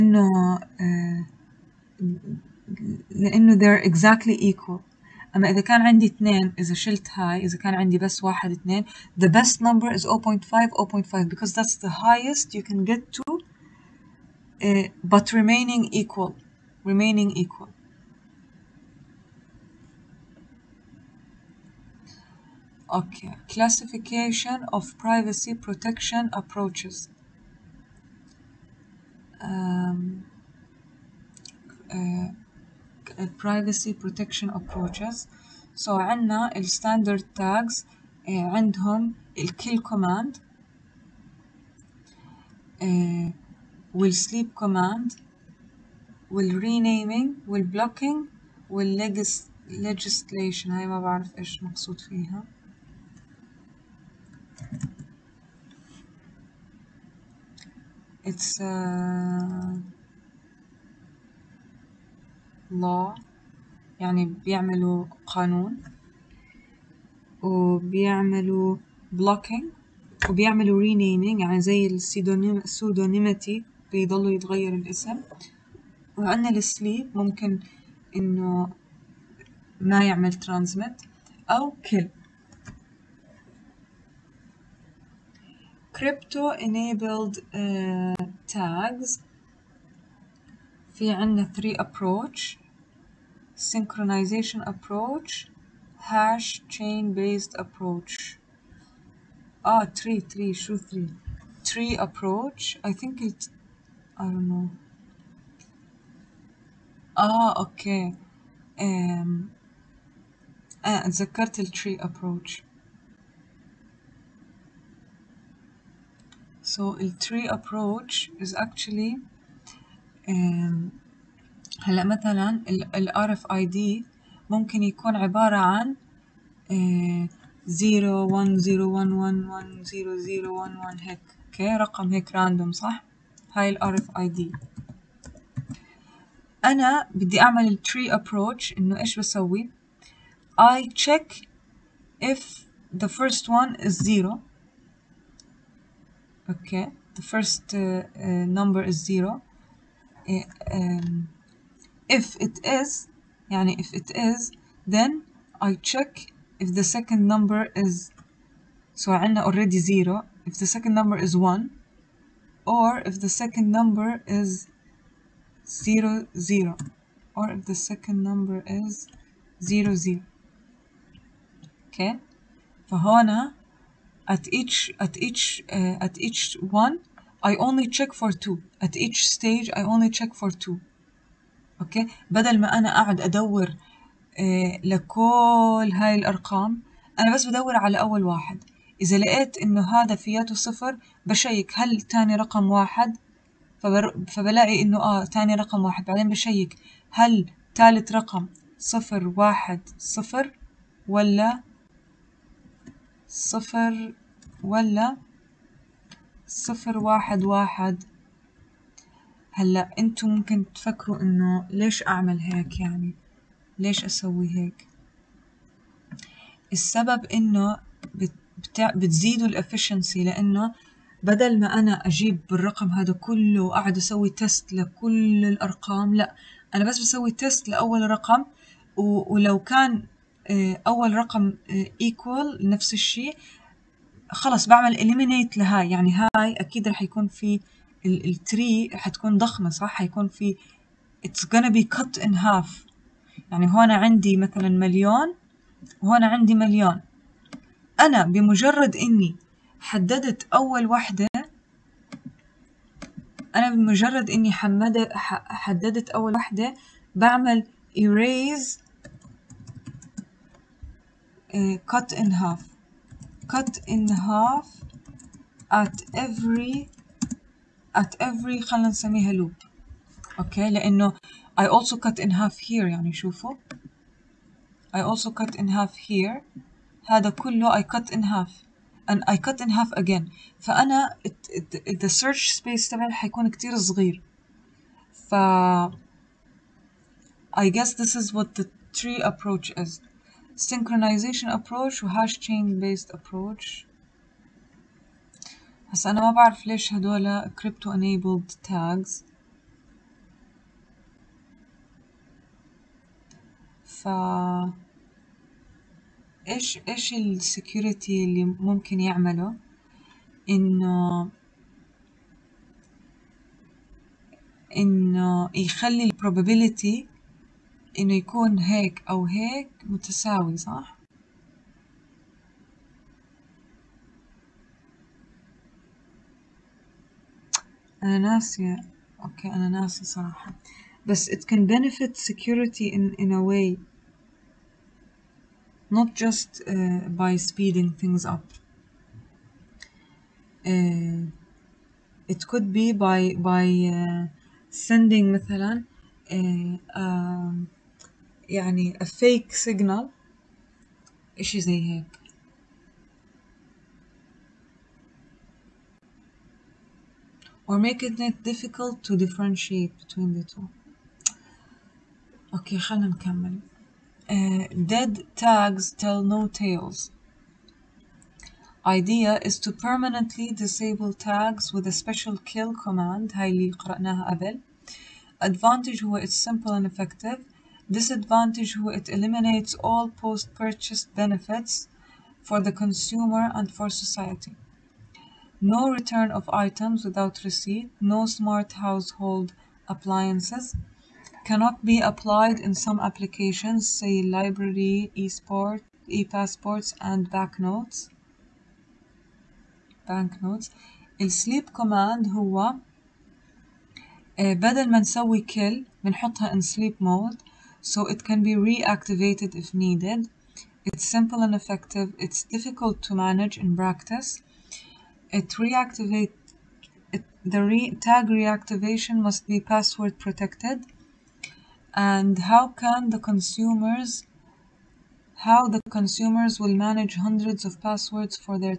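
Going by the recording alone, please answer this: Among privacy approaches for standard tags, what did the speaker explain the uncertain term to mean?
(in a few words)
law.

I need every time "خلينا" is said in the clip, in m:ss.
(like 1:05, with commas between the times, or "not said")
4:28.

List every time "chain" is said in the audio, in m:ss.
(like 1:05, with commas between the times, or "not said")
1:36, 4:52.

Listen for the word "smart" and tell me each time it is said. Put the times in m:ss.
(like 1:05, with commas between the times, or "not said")
6:28.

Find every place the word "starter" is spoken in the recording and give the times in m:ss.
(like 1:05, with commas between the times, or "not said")
not said.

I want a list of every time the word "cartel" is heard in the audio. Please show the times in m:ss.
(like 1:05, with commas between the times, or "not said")
1:51.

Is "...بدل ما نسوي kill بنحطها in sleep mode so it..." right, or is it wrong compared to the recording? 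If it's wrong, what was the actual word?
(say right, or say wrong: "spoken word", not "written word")
right.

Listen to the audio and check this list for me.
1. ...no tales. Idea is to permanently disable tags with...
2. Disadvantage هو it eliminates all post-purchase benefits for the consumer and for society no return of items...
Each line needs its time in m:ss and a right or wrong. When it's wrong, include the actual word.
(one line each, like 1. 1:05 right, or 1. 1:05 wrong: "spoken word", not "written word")
1. 6:06 right
2. 6:17 right.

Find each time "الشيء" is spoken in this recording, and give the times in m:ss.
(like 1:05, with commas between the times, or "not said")
3:52.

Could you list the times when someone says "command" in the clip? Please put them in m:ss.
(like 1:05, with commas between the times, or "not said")
0:39, 0:44, 6:12, 6:41.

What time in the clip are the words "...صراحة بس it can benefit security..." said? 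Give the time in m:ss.
5:30.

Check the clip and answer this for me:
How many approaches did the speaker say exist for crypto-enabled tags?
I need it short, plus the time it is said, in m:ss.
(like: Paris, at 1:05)
3, at 1:31.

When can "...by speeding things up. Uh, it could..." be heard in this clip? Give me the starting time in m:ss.
5:37.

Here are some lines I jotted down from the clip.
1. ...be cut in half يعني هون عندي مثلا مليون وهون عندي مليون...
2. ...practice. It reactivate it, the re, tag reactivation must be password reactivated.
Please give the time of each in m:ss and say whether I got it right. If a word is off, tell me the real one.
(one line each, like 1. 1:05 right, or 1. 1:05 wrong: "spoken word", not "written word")
1. 4:01 right
2. 6:53 wrong: "protected", not "reactivated".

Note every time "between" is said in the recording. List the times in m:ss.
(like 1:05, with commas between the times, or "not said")
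6:00.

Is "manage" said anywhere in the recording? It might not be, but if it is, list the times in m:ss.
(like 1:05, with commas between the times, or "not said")
6:53, 7:06.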